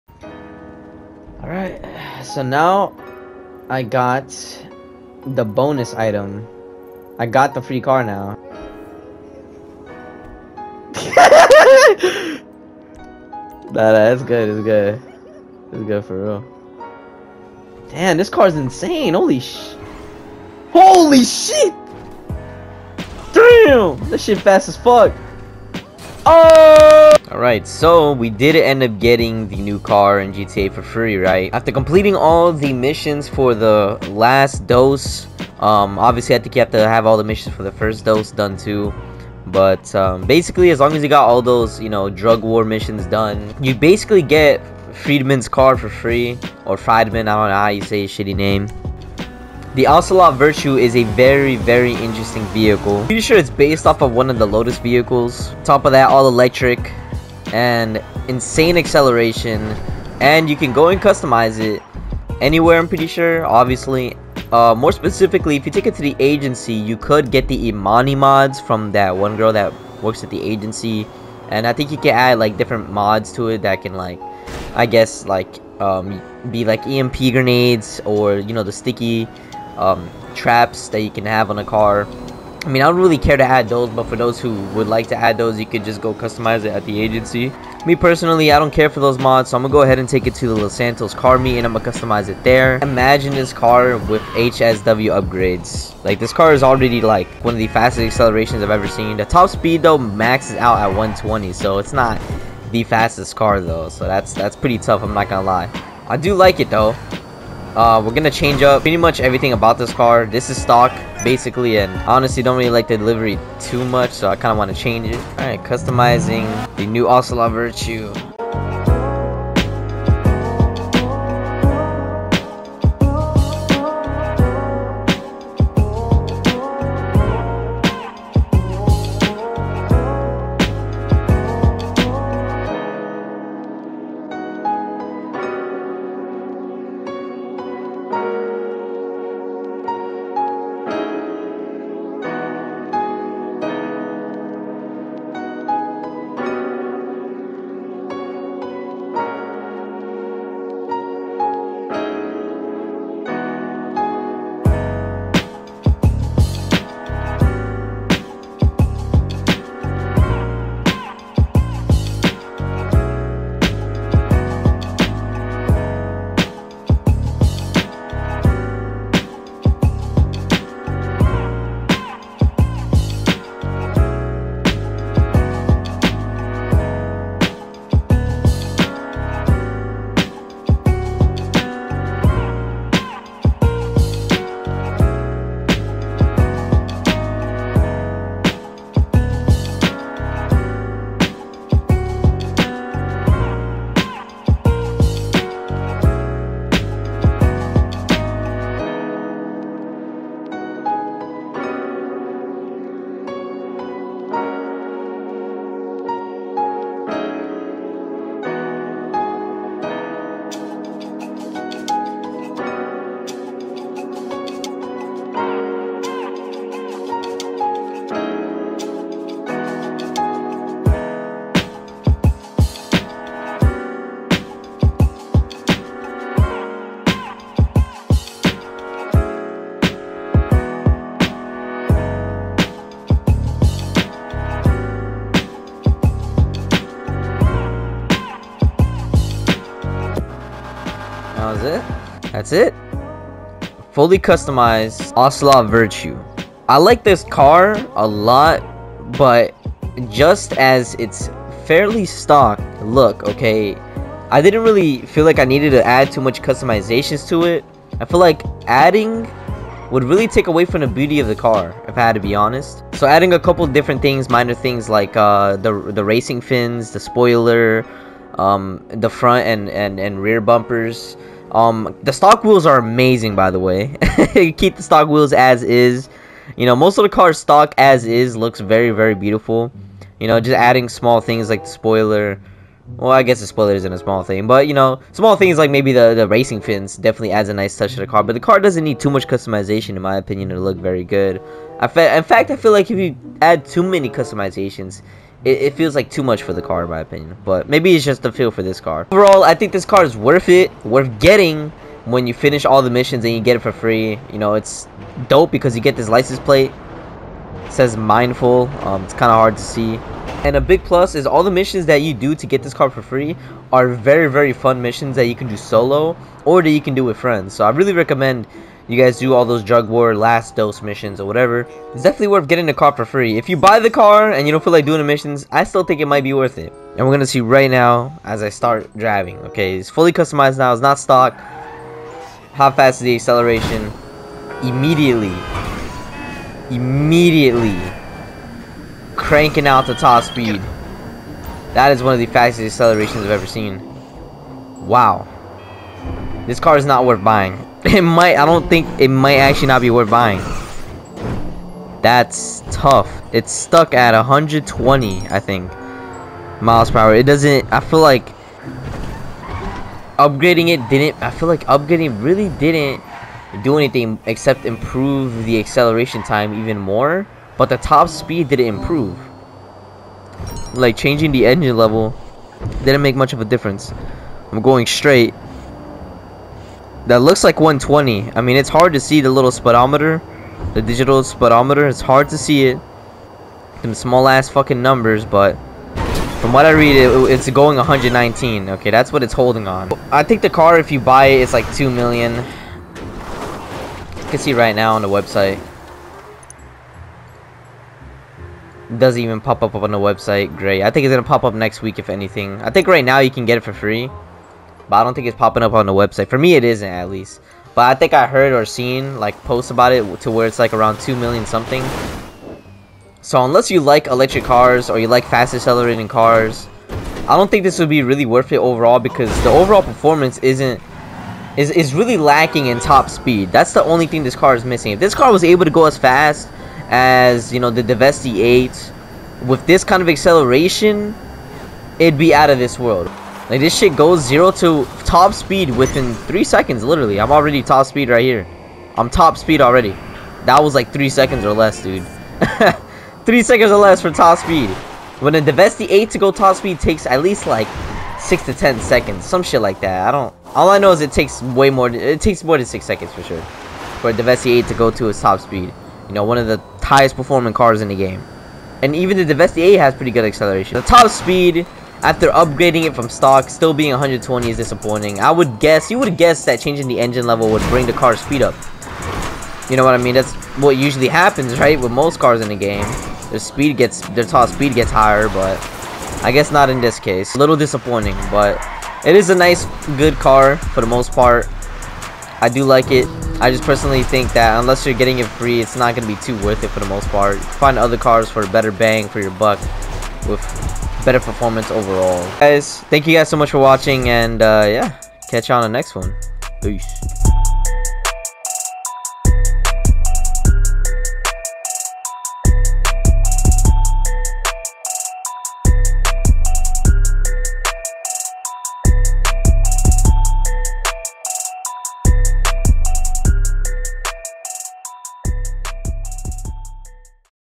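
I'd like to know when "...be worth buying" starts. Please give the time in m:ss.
5:49.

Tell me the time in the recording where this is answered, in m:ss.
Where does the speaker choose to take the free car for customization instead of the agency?
1:30.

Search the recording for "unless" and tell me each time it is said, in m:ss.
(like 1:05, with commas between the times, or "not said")
6:53, 8:04.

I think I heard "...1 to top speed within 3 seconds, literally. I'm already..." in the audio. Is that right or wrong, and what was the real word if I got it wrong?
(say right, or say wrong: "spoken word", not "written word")
wrong: "0", not "1".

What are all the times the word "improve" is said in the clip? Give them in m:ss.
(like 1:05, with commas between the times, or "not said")
6:04, 6:08.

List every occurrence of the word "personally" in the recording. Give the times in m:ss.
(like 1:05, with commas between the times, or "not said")
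1:27, 8:03.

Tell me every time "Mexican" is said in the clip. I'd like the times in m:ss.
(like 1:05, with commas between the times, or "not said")
not said.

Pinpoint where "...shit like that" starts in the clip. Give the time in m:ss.
7:29.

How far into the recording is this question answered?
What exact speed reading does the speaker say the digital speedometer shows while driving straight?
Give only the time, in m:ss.
6:27.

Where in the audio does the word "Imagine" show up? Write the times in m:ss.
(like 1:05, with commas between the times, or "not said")
1:32.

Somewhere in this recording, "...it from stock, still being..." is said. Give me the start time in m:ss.
7:42.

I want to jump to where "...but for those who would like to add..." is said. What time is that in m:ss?
1:23.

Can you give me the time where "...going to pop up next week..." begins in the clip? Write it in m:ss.
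6:41.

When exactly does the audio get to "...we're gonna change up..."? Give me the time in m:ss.
1:48.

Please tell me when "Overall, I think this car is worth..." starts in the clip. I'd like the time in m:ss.
4:59.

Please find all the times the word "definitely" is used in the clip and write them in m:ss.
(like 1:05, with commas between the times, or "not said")
4:46, 5:22.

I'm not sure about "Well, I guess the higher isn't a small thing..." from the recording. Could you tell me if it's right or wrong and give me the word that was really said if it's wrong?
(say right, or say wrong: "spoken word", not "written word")
wrong: "spoiler", not "higher".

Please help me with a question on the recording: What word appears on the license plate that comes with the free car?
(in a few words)
mindful.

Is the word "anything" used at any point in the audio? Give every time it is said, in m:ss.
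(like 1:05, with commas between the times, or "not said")
6:03, 6:42.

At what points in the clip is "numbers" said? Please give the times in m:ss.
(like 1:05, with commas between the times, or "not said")
6:24.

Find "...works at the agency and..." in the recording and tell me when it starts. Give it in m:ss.
1:10.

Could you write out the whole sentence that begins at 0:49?
The Ocelot Virtue is a very, very interesting vehicle.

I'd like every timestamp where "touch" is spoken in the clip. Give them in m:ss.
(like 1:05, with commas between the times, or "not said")
4:47.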